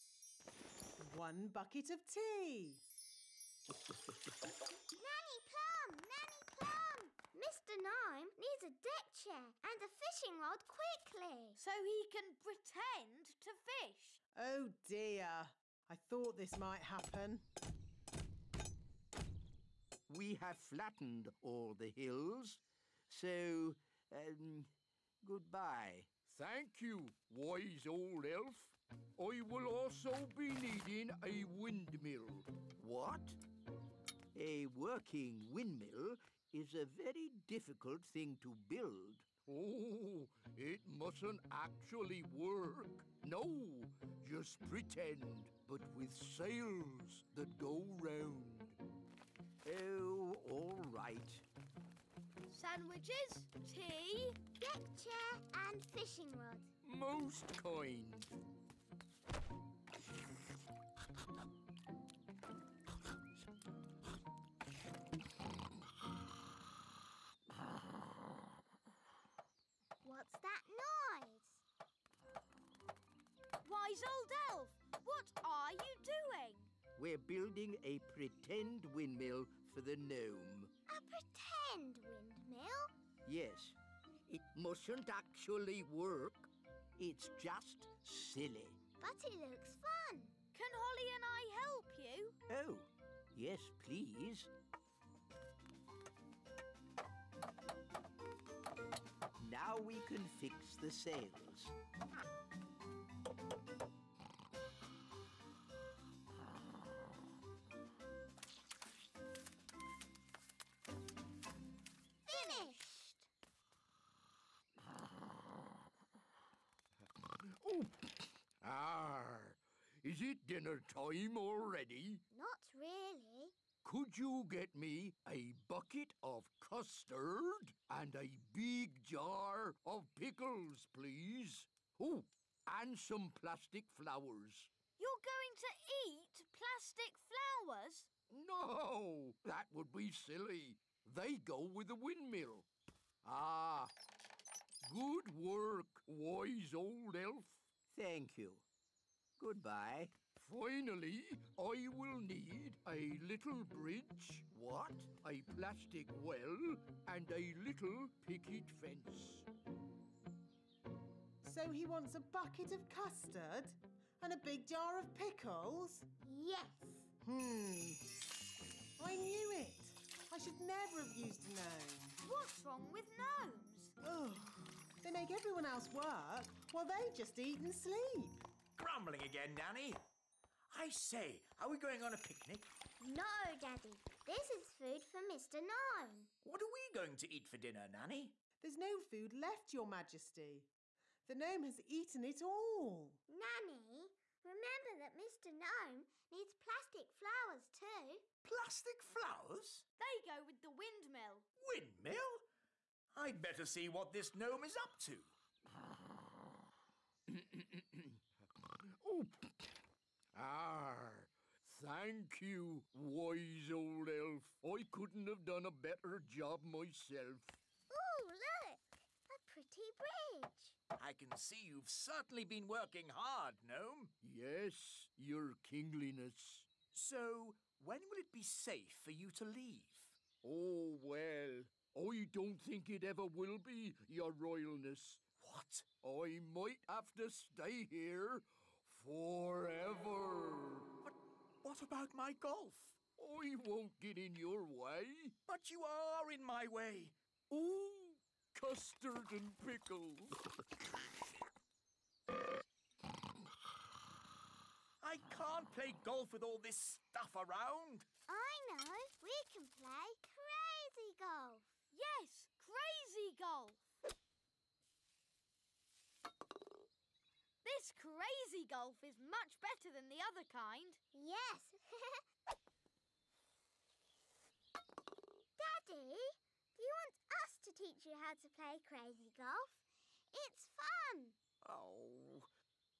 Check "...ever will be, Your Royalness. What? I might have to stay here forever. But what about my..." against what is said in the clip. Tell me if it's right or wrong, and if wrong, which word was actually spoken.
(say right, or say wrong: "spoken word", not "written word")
right.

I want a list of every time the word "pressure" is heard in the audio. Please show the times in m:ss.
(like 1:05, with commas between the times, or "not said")
not said.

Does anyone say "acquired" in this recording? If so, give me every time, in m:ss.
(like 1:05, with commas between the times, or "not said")
not said.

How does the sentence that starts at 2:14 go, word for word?
You're going to eat plastic flowers?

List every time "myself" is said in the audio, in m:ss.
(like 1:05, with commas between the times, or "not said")
3:36.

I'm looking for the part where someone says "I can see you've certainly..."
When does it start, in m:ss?
3:40.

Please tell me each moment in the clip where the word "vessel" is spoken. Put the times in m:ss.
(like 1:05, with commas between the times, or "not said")
not said.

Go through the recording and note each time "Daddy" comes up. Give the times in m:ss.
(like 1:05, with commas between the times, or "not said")
3:03, 4:34.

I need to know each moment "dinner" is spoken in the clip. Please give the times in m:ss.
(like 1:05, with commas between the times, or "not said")
2:00, 3:07.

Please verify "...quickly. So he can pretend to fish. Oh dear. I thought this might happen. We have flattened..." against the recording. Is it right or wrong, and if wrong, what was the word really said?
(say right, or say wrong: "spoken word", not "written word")
right.